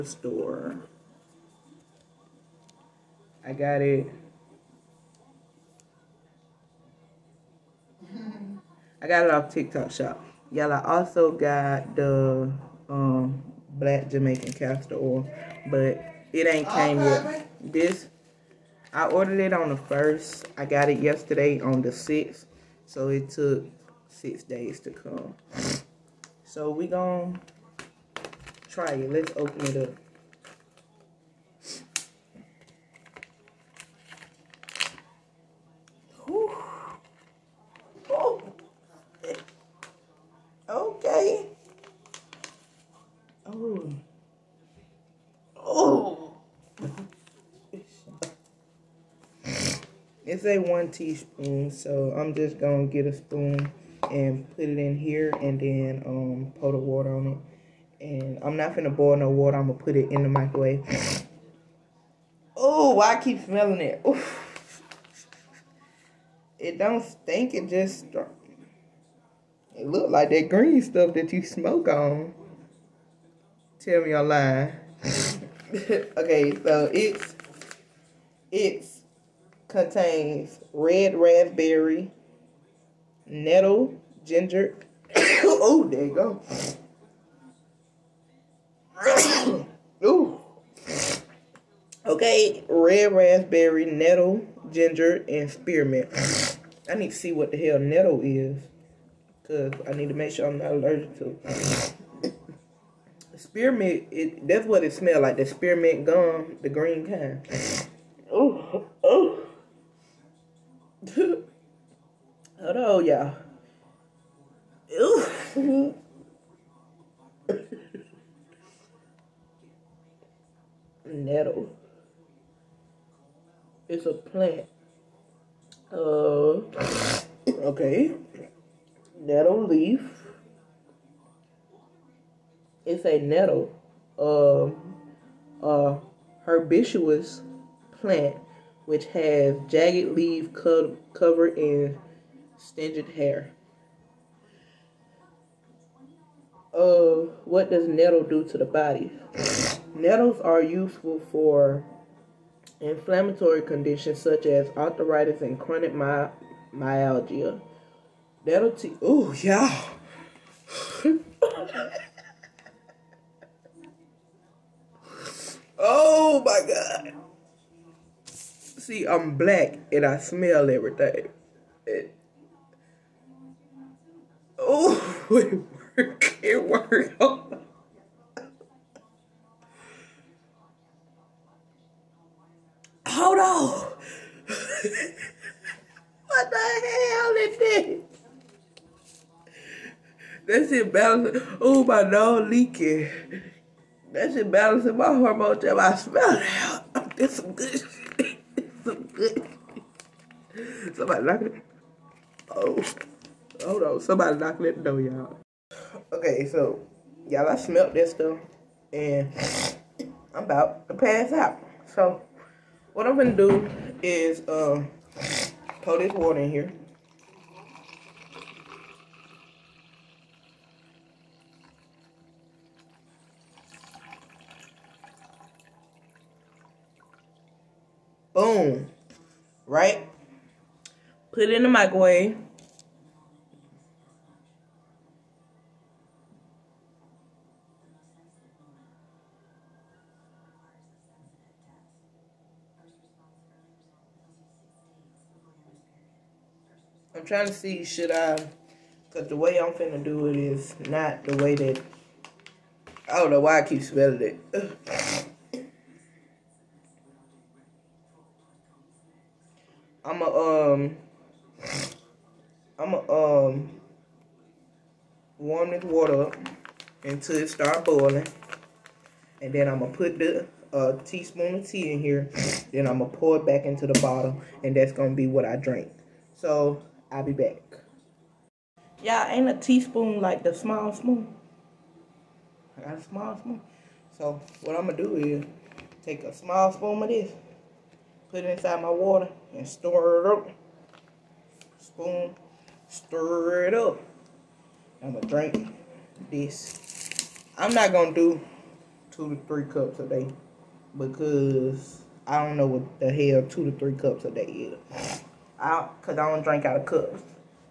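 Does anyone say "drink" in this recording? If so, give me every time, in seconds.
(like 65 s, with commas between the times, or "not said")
275 s, 295 s, 306 s.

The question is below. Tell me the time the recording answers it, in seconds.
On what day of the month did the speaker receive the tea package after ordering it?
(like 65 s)
21 s.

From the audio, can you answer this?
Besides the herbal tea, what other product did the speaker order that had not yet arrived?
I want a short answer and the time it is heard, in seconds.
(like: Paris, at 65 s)
Black Jamaican castor oil, at 13 s.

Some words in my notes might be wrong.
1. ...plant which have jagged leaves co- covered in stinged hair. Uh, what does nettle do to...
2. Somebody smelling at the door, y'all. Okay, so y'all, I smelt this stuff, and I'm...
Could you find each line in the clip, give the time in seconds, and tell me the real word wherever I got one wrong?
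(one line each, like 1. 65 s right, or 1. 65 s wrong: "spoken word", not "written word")
1. 138 s right
2. 203 s wrong: "knocking", not "smelling".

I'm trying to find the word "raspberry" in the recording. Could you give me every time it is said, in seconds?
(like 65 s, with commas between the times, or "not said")
81 s, 93 s.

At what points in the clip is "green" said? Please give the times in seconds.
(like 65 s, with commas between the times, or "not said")
70 s, 106 s.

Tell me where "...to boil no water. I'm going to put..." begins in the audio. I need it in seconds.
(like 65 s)
58 s.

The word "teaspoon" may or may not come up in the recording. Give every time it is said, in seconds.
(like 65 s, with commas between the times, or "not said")
50 s, 271 s, 279 s.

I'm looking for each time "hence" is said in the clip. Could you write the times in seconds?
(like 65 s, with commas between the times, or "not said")
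not said.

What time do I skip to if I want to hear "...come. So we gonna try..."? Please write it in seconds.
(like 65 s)
24 s.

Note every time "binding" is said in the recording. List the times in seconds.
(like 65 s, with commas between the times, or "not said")
not said.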